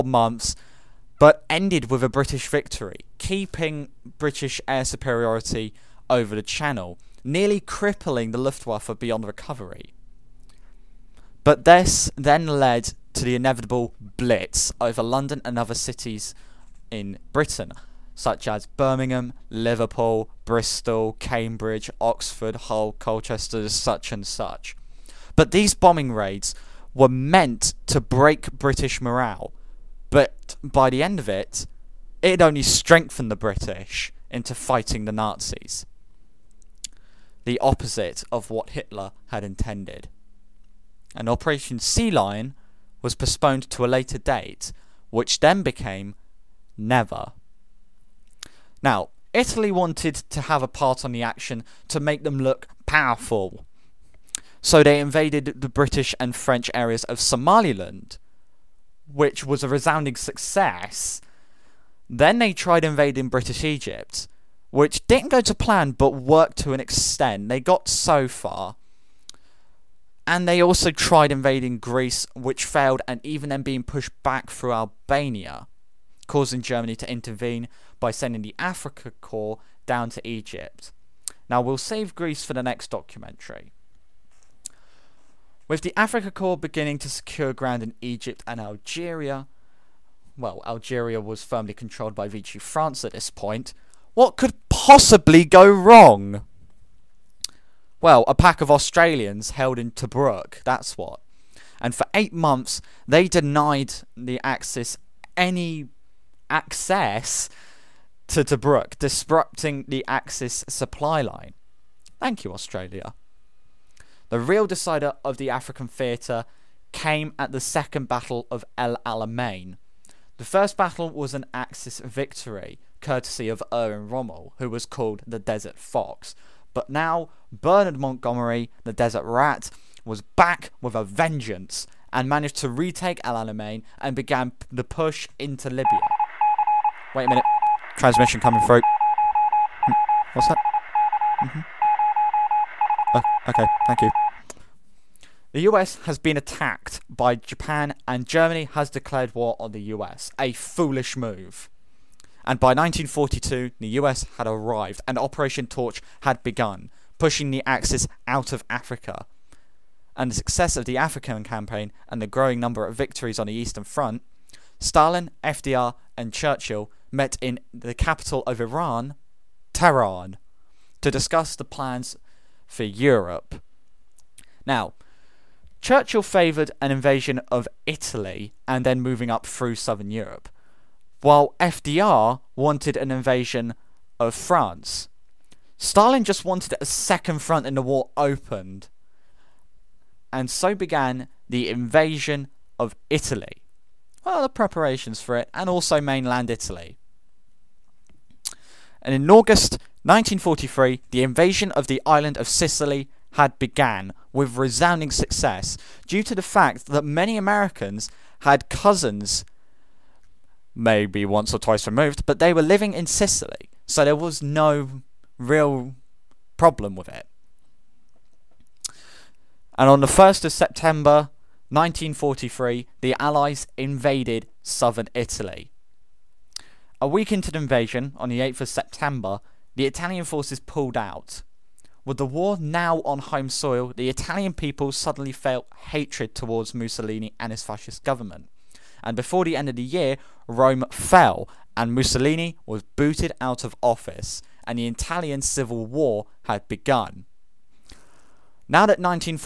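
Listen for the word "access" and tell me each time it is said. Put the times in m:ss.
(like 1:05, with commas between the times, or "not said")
1:46.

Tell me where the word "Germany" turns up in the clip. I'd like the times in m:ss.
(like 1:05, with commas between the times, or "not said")
1:16, 2:28.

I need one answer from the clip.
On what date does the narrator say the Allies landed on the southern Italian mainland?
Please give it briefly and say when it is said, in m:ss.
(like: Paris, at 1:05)
1st of September 1943, at 3:40.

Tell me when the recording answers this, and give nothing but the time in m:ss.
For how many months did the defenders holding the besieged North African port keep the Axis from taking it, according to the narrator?
1:42.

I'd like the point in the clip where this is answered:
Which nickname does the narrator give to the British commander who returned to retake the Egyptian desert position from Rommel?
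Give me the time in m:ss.
2:08.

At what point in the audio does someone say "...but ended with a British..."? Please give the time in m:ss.
0:01.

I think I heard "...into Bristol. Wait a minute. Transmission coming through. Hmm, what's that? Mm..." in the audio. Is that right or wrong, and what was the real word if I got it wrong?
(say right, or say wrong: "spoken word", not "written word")
wrong: "Libya", not "Bristol".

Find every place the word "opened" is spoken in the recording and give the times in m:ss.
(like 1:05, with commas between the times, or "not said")
3:08.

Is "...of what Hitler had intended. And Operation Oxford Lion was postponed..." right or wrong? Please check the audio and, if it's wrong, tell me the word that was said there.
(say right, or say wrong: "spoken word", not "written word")
wrong: "Sea", not "Oxford".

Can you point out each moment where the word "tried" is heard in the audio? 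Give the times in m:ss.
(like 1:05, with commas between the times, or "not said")
1:02, 1:10.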